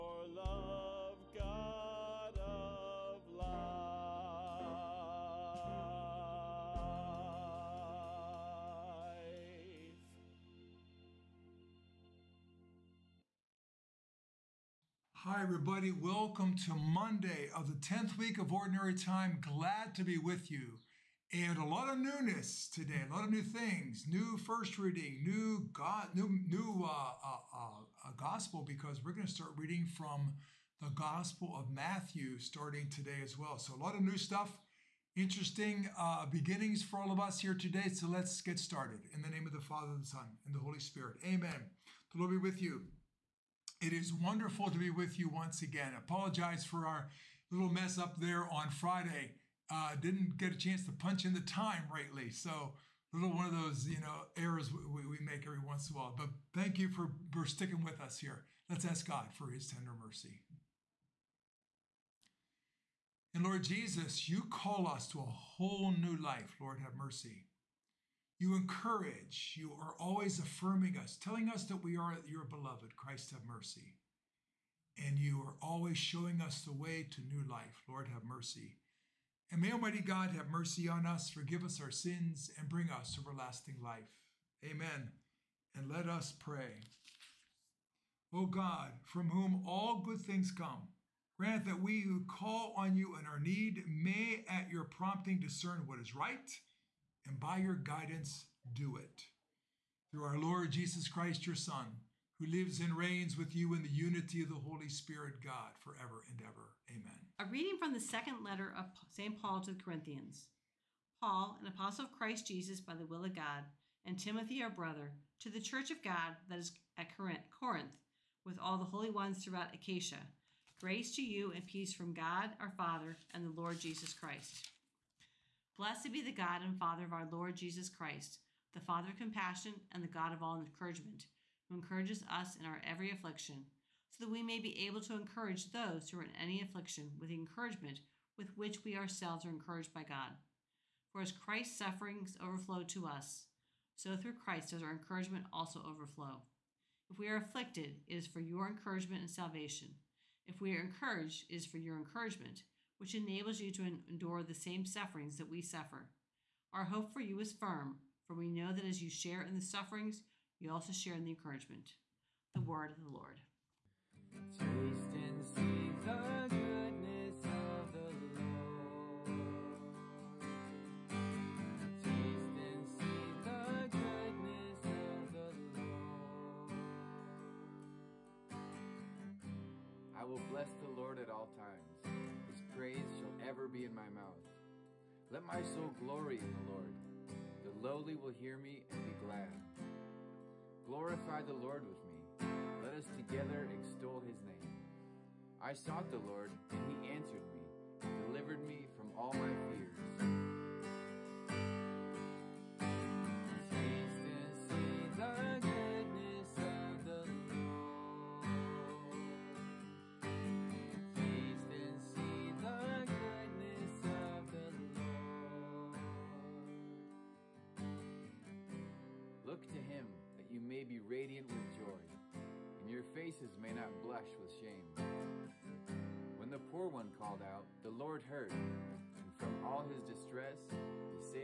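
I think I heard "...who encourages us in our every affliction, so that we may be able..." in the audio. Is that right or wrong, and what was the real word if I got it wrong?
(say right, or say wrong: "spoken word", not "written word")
right.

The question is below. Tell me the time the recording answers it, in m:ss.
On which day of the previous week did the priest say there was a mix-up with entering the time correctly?
0:48.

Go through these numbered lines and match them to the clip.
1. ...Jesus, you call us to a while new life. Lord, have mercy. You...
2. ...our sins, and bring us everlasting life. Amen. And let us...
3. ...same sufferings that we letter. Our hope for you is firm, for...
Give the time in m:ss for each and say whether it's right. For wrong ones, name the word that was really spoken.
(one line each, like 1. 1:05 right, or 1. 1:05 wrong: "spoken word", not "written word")
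1. 1:03 wrong: "whole", not "while"
2. 1:21 right
3. 2:34 wrong: "suffer", not "letter".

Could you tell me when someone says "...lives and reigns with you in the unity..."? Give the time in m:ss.
1:42.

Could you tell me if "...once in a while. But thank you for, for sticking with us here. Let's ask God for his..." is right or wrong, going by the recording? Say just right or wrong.
right.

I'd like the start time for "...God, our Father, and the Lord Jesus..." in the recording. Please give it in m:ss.
2:02.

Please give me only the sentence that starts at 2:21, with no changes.
For as Christ's sufferings overflow to us, so through Christ does our encouragement also overflow.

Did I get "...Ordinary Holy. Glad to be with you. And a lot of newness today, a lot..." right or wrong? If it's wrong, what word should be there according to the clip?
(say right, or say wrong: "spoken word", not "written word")
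wrong: "Time", not "Holy".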